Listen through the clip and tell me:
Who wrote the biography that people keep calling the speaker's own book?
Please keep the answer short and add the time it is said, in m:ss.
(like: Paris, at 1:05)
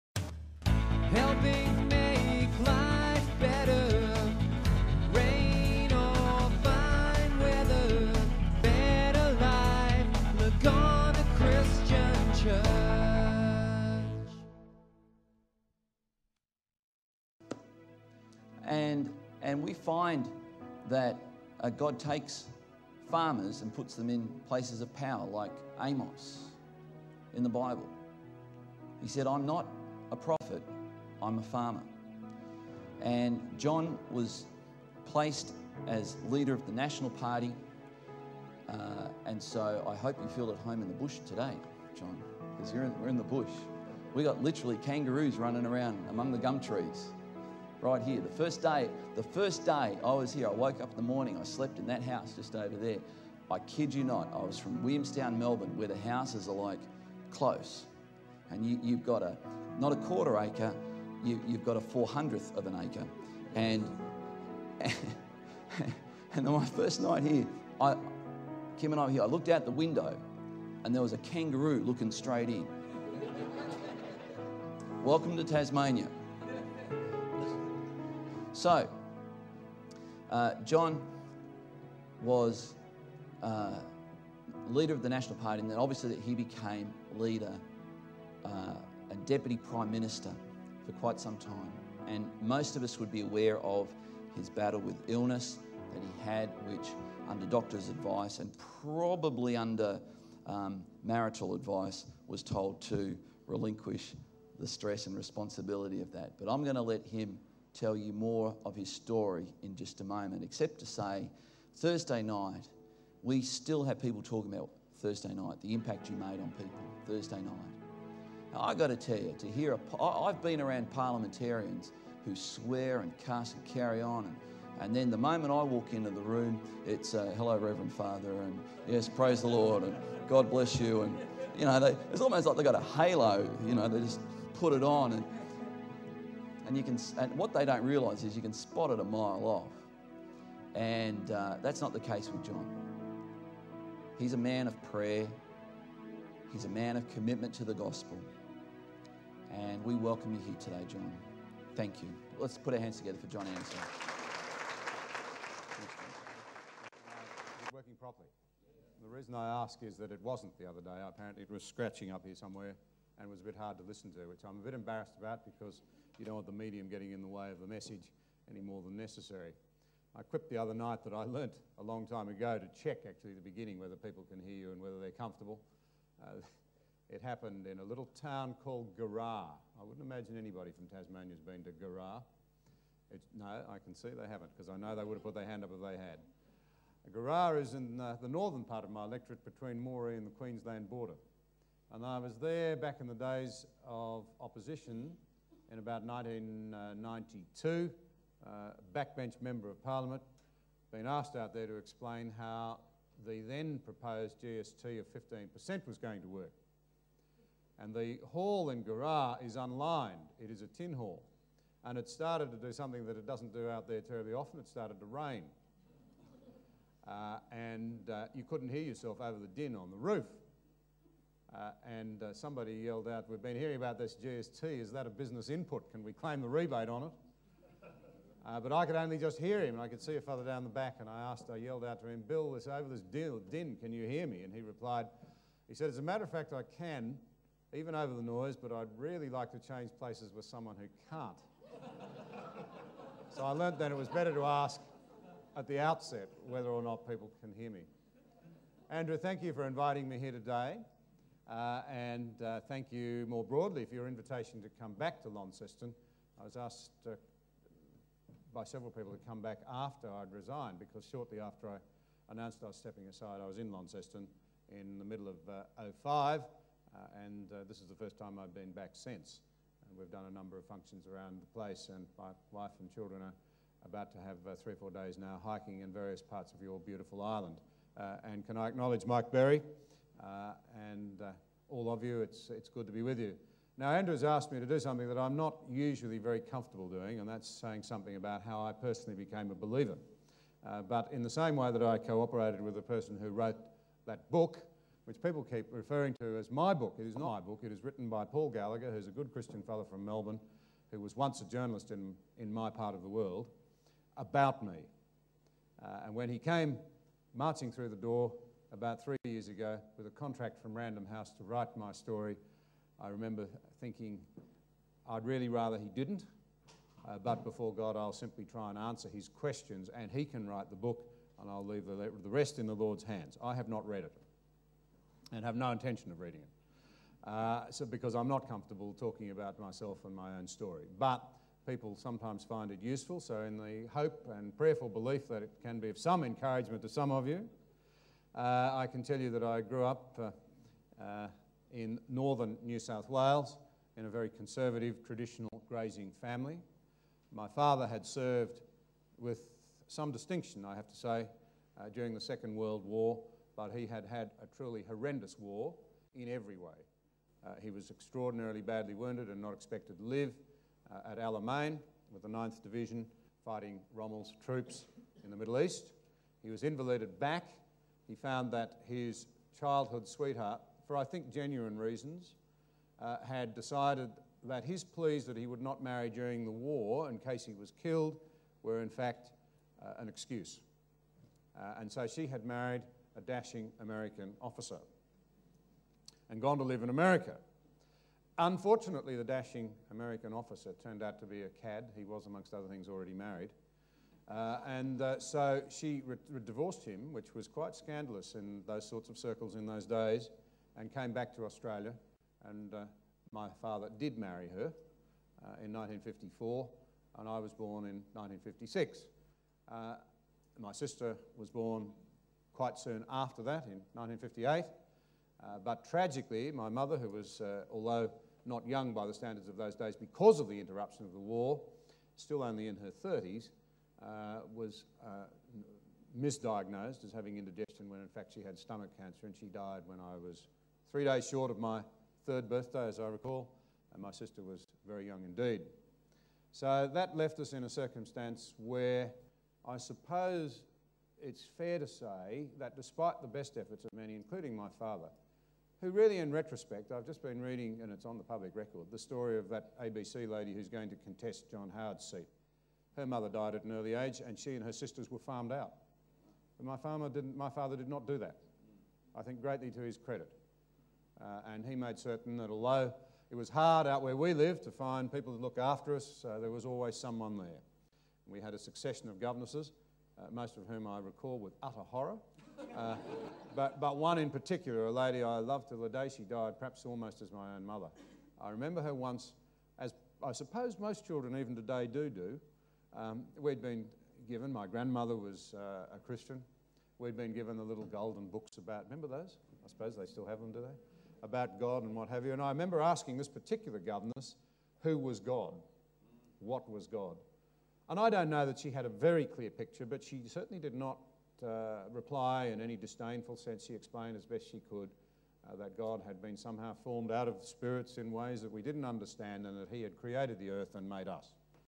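Paul Gallagher, at 4:58.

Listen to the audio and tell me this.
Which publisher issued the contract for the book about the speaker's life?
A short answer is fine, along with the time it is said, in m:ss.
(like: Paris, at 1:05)
Random House, at 5:10.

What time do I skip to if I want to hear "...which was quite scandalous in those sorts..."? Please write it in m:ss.
6:37.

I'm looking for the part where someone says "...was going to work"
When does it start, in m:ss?
3:25.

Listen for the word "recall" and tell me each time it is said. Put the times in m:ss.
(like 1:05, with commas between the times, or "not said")
7:13, 7:50.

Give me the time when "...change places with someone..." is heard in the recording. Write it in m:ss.
3:59.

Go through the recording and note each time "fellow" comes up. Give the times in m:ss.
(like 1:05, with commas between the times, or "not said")
3:50, 4:59.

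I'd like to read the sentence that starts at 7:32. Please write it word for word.
Her mother died at an early age, and she and her sisters were farmed out.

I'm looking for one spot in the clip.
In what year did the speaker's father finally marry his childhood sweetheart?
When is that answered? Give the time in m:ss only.
6:45.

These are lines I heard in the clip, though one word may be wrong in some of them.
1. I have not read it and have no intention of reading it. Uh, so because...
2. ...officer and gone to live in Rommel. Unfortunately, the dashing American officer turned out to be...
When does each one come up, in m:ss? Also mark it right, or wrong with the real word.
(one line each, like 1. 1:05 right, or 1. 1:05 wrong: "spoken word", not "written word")
1. 5:23 right
2. 6:24 wrong: "America", not "Rommel".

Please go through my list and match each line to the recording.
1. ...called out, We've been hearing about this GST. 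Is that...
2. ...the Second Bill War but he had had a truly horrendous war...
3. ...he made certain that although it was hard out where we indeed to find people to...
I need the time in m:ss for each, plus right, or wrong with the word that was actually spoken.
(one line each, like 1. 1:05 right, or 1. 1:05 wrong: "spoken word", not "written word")
1. 3:42 wrong: "yelled", not "called"
2. 5:52 wrong: "World", not "Bill"
3. 7:41 wrong: "lived", not "indeed".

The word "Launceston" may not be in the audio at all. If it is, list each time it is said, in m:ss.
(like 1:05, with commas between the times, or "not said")
4:15, 4:23.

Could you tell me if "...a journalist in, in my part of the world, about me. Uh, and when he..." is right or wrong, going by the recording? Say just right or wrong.
right.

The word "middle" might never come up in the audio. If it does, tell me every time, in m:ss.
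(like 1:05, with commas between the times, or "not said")
4:25, 6:05.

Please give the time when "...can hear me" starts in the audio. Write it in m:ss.
4:07.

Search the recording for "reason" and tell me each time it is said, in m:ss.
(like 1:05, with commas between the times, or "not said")
2:39, 6:11.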